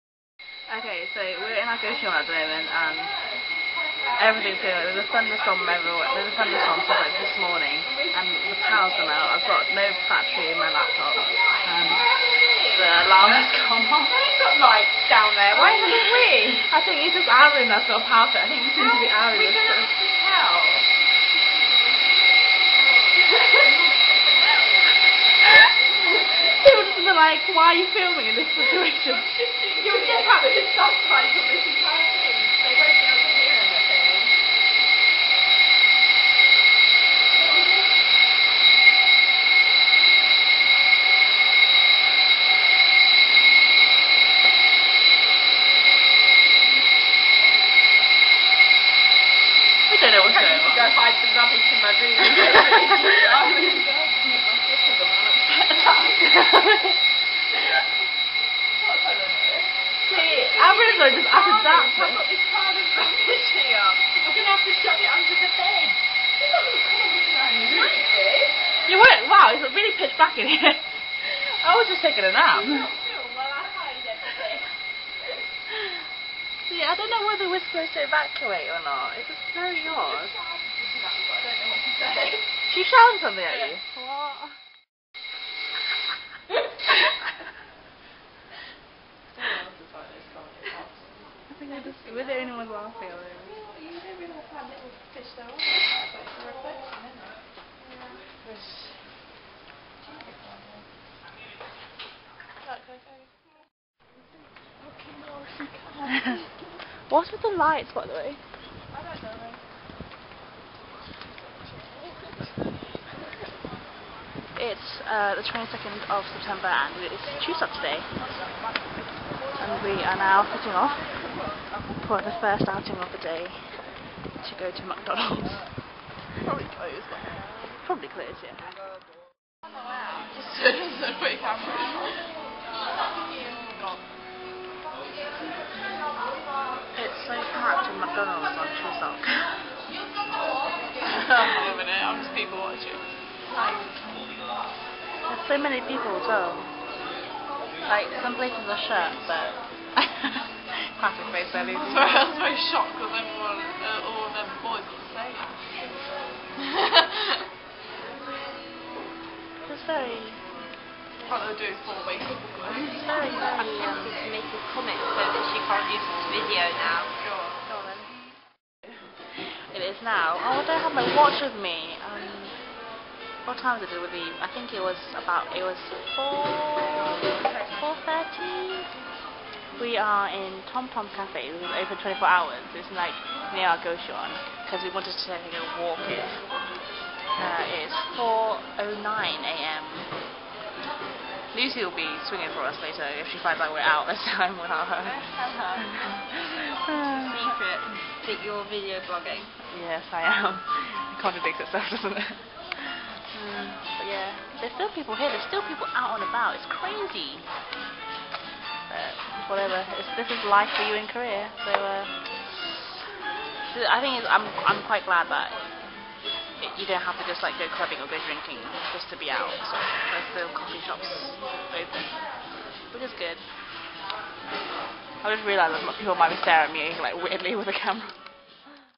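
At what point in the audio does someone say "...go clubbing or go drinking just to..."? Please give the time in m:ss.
3:37.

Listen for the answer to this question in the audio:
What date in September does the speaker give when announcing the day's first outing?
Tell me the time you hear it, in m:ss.
1:55.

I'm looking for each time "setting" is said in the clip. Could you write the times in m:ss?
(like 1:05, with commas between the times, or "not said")
2:00.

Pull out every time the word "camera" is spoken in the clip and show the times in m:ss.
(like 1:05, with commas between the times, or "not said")
2:11, 3:47.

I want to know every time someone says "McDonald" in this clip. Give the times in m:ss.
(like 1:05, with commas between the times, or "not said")
2:04.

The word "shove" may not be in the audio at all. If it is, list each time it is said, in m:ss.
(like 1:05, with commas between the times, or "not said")
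1:04.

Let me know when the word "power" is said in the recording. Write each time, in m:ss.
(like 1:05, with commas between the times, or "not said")
0:08, 0:18.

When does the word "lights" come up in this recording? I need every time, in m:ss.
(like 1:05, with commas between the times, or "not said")
0:14, 1:47.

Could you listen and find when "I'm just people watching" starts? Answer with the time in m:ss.
2:22.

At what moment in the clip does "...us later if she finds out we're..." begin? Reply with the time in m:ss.
3:12.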